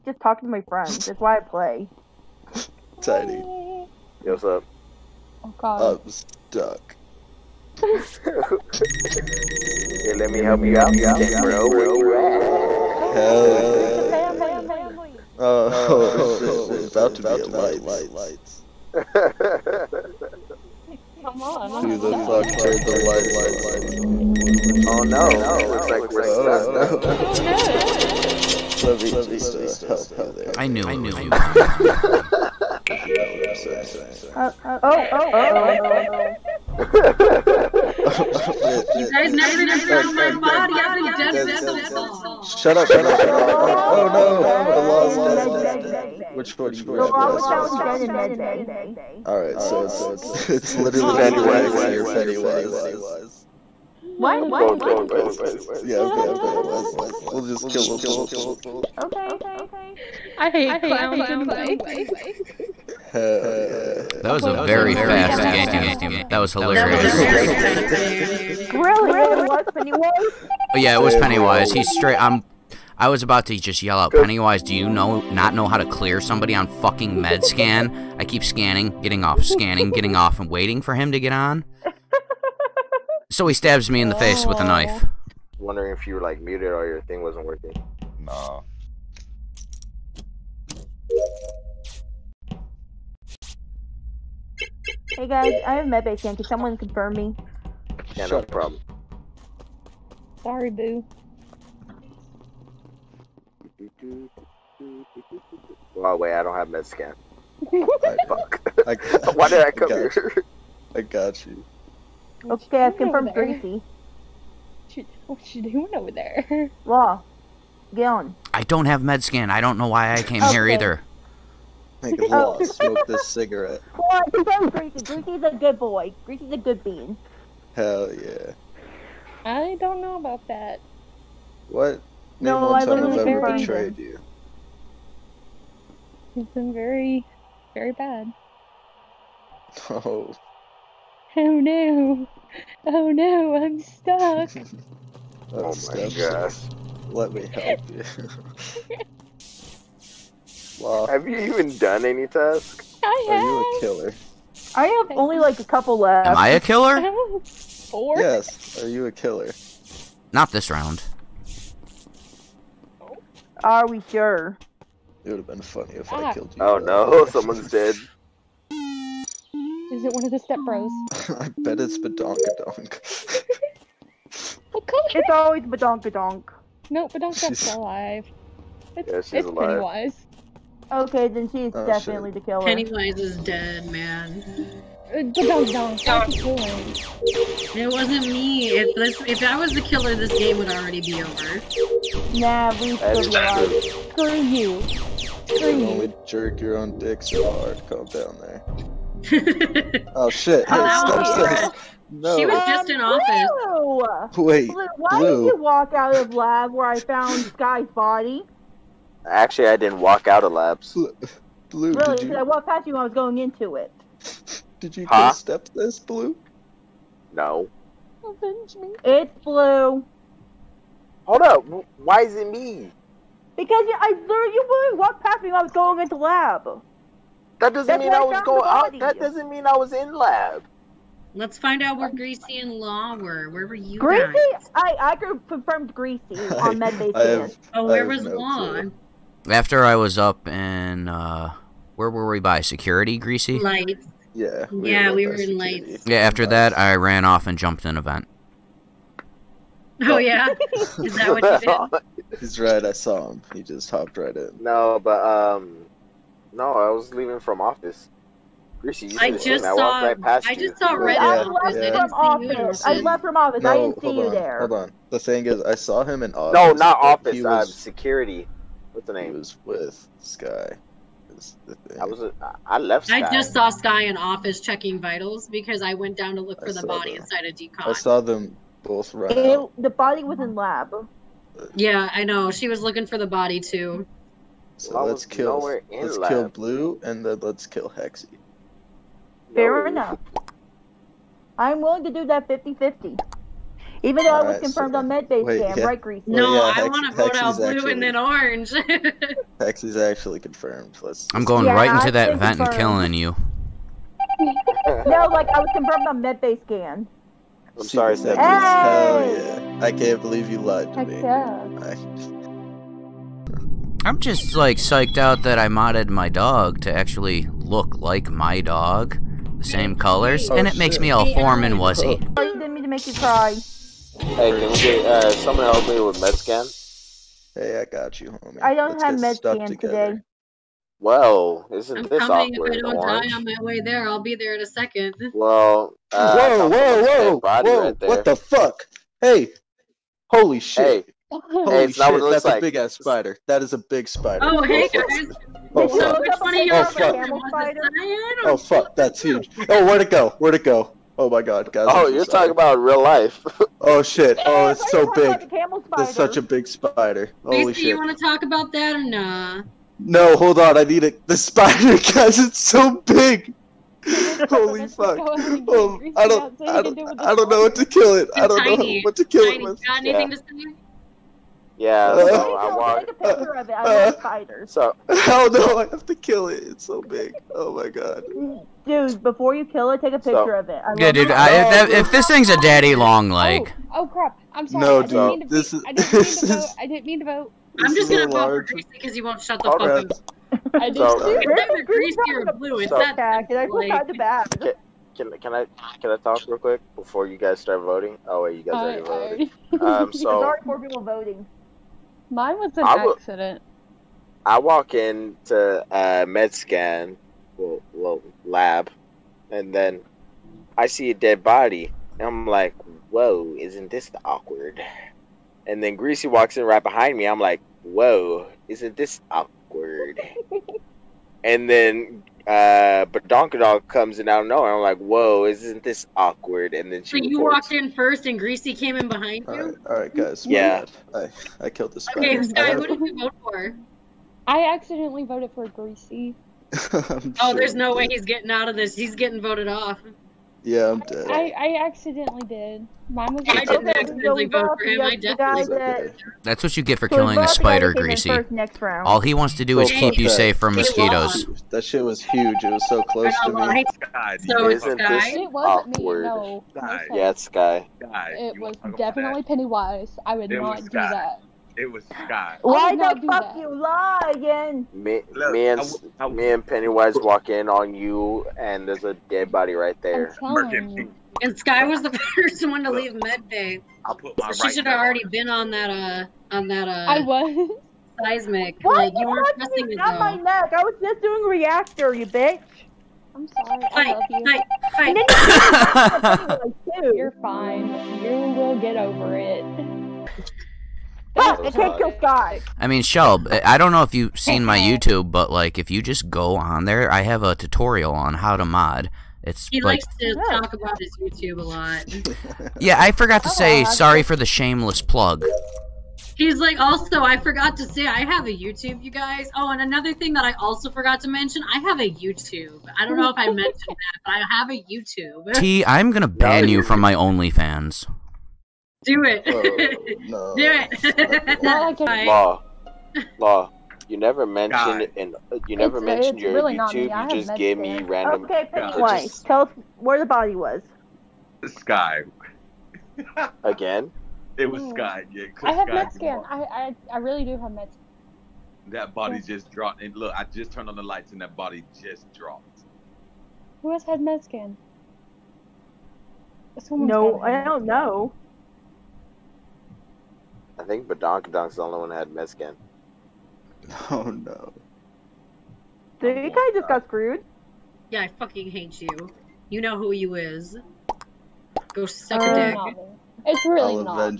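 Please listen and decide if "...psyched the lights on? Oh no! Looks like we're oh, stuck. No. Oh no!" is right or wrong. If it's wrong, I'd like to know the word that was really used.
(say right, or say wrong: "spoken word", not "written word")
wrong: "turned", not "psyched".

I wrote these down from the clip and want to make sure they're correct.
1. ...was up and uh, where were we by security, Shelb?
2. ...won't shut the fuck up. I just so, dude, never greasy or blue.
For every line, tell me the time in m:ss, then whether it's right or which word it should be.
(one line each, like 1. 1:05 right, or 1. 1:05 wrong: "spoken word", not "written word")
1. 3:59 wrong: "Greasy", not "Shelb"
2. 6:29 right.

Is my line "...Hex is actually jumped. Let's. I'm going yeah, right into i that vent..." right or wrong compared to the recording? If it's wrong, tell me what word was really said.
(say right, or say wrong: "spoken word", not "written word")
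wrong: "confirmed", not "jumped".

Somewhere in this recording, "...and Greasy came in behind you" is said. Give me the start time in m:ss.
7:08.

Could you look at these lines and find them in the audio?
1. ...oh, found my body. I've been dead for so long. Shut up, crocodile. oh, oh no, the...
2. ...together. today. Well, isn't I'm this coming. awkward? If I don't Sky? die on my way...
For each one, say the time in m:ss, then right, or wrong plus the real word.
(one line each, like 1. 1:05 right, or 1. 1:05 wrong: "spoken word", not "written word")
1. 0:39 right
2. 5:29 wrong: "Orange", not "Sky".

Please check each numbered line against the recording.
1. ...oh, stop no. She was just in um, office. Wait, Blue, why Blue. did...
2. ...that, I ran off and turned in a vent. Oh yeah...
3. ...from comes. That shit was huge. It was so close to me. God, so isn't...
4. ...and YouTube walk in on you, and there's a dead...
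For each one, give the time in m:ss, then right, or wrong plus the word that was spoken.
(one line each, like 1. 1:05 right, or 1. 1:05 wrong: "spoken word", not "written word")
1. 3:20 right
2. 4:06 wrong: "jumped", not "turned"
3. 7:30 wrong: "mosquitoes", not "comes"
4. 7:46 wrong: "Pennywise", not "YouTube".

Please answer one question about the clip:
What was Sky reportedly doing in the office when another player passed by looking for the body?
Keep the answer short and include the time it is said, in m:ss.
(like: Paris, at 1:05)
checking vitals, at 4:34.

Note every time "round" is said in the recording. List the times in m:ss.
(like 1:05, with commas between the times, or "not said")
2:40, 7:28.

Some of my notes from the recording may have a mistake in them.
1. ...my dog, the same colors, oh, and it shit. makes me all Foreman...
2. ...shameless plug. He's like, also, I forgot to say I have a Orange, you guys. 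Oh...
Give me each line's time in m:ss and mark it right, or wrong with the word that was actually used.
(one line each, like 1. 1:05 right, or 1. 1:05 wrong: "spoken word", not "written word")
1. 5:18 right
2. 8:24 wrong: "YouTube", not "Orange".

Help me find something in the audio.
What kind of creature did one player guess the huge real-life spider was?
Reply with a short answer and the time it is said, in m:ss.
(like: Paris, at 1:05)
daddy long leg, at 6:22.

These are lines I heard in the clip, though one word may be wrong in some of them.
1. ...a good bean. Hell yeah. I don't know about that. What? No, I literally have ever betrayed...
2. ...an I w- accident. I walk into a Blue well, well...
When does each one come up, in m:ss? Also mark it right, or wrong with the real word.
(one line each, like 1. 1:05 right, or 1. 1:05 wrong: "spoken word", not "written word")
1. 2:06 right
2. 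6:42 wrong: "MedScan", not "Blue".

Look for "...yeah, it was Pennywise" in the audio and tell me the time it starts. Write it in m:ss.
1:10.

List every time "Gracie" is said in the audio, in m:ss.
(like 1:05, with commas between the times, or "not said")
1:53.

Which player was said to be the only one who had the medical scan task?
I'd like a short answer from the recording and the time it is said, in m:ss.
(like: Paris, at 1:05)
Badonkadon, at 9:11.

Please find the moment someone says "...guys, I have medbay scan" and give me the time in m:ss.
1:35.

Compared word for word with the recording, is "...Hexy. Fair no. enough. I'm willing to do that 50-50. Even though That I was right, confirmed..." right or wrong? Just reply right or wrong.
wrong.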